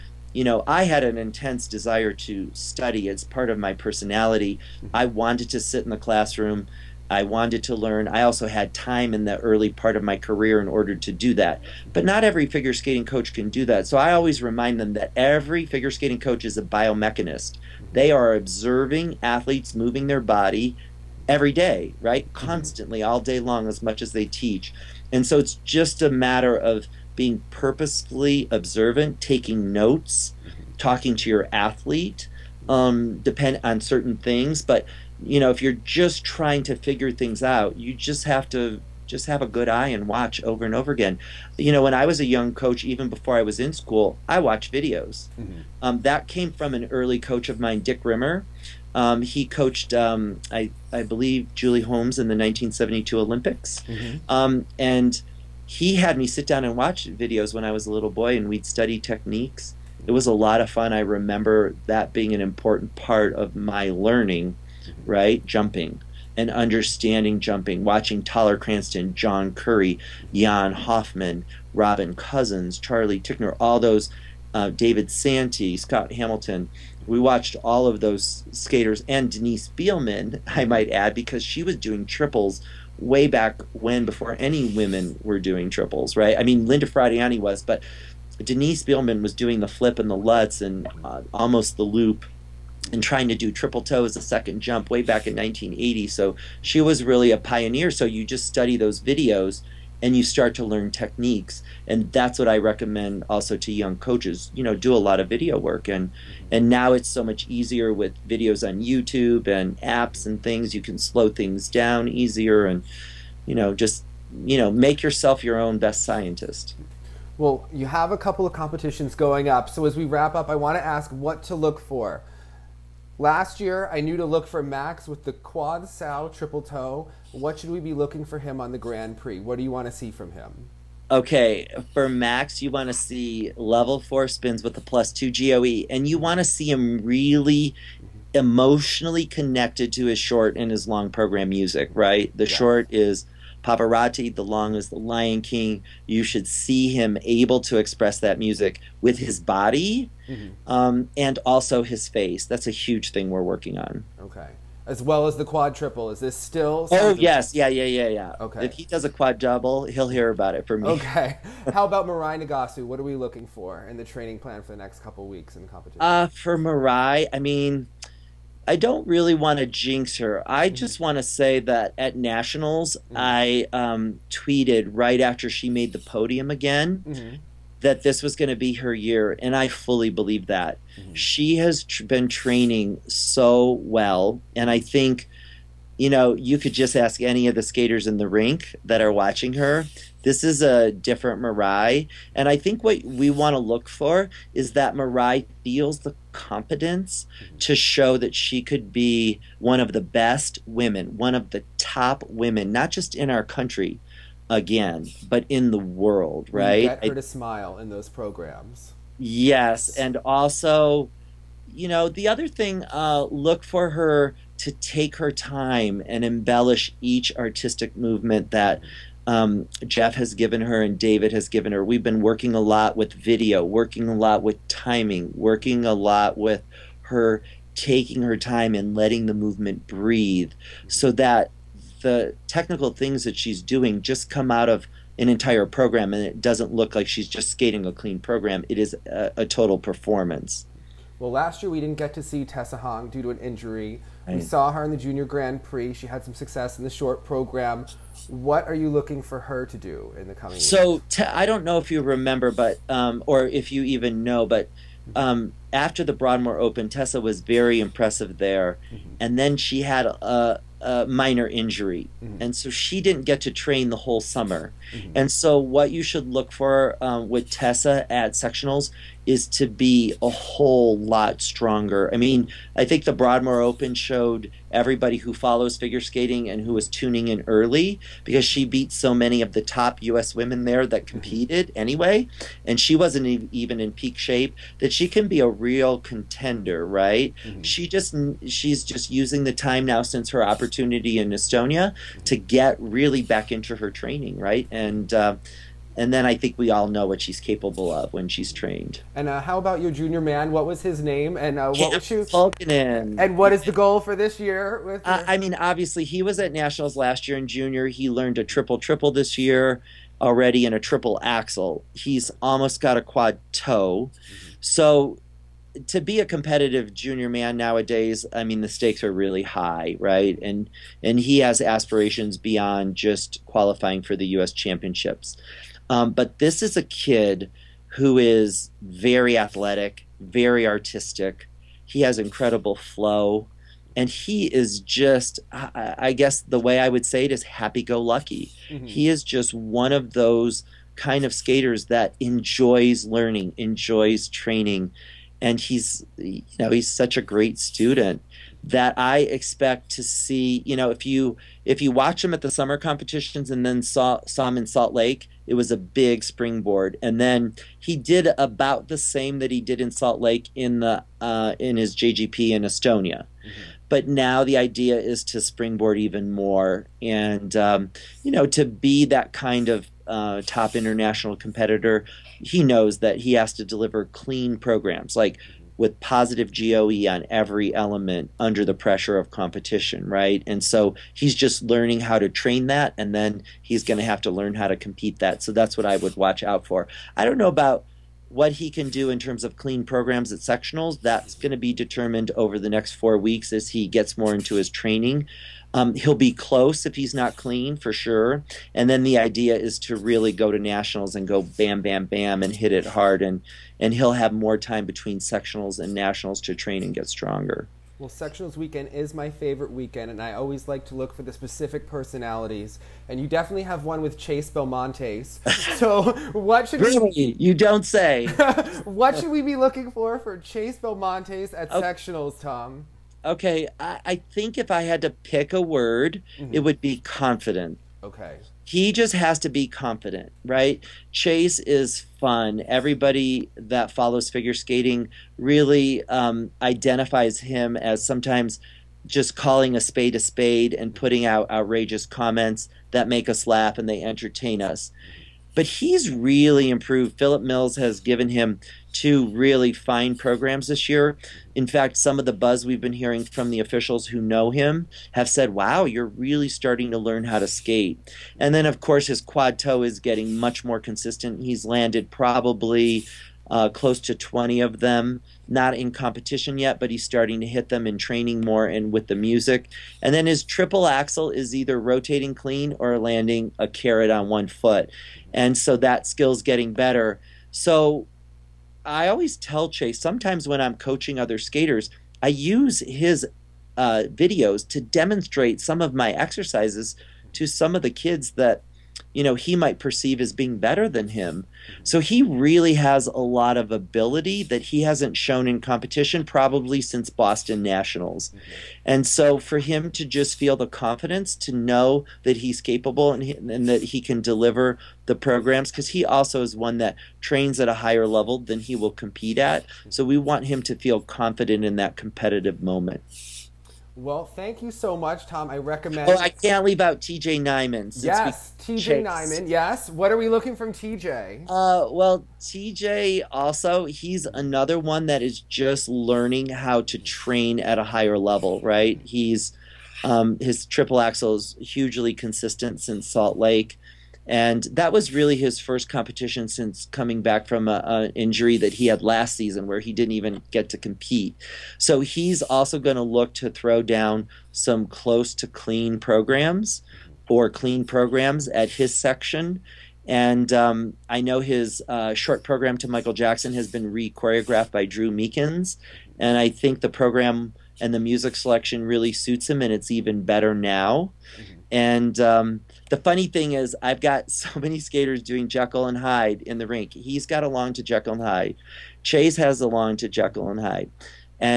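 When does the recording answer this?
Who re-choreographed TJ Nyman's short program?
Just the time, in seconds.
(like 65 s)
554 s.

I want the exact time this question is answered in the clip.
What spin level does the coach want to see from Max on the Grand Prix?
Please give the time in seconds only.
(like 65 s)
133 s.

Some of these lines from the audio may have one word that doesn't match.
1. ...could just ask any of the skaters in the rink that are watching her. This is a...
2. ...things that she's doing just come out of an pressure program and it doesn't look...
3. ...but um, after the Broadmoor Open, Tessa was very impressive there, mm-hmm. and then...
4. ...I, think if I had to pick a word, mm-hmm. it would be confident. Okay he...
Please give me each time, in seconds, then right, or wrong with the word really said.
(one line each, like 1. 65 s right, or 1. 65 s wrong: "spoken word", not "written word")
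1. 186 s right
2. 232 s wrong: "entire", not "pressure"
3. 254 s right
4. 424 s right.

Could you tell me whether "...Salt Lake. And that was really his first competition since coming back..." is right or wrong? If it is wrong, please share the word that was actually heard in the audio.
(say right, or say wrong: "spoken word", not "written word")
right.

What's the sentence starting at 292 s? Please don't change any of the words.
to get really back into her training, right?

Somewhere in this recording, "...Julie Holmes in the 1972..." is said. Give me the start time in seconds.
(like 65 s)
51 s.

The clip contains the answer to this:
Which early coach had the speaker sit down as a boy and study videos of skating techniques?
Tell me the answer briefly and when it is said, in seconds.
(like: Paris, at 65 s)
Dick Rimmer, at 47 s.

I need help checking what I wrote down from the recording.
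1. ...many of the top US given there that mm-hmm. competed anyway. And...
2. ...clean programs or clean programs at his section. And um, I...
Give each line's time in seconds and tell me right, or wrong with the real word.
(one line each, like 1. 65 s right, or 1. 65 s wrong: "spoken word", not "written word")
1. 279 s wrong: "women", not "given"
2. 545 s right.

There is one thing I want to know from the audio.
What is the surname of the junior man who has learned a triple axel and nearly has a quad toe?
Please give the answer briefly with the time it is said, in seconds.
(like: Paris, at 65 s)
Pulkinen, at 302 s.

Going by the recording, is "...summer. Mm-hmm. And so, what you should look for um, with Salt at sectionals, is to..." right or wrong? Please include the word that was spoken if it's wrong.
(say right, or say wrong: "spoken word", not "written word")
wrong: "Tessa", not "Salt".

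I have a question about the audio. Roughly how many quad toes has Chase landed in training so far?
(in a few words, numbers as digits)
20.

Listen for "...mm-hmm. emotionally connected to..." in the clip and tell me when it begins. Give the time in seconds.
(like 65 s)
138 s.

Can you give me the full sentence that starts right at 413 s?
And you definitely have one with Chase Belmontes.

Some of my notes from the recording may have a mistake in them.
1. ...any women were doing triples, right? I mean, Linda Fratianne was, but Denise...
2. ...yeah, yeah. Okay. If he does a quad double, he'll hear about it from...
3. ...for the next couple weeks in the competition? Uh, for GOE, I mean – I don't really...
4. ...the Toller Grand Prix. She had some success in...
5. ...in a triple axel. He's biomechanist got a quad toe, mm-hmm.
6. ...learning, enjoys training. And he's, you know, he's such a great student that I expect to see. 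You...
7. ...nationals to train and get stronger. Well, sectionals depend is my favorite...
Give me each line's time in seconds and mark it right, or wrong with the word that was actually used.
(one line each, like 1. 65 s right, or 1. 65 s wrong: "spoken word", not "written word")
1. 84 s right
2. 157 s right
3. 164 s wrong: "Mirai", not "GOE"
4. 244 s wrong: "Junior", not "Toller"
5. 310 s wrong: "almost", not "biomechanist"
6. 343 s right
7. 405 s wrong: "weekend", not "depend".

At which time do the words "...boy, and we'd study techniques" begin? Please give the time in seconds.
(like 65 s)
58 s.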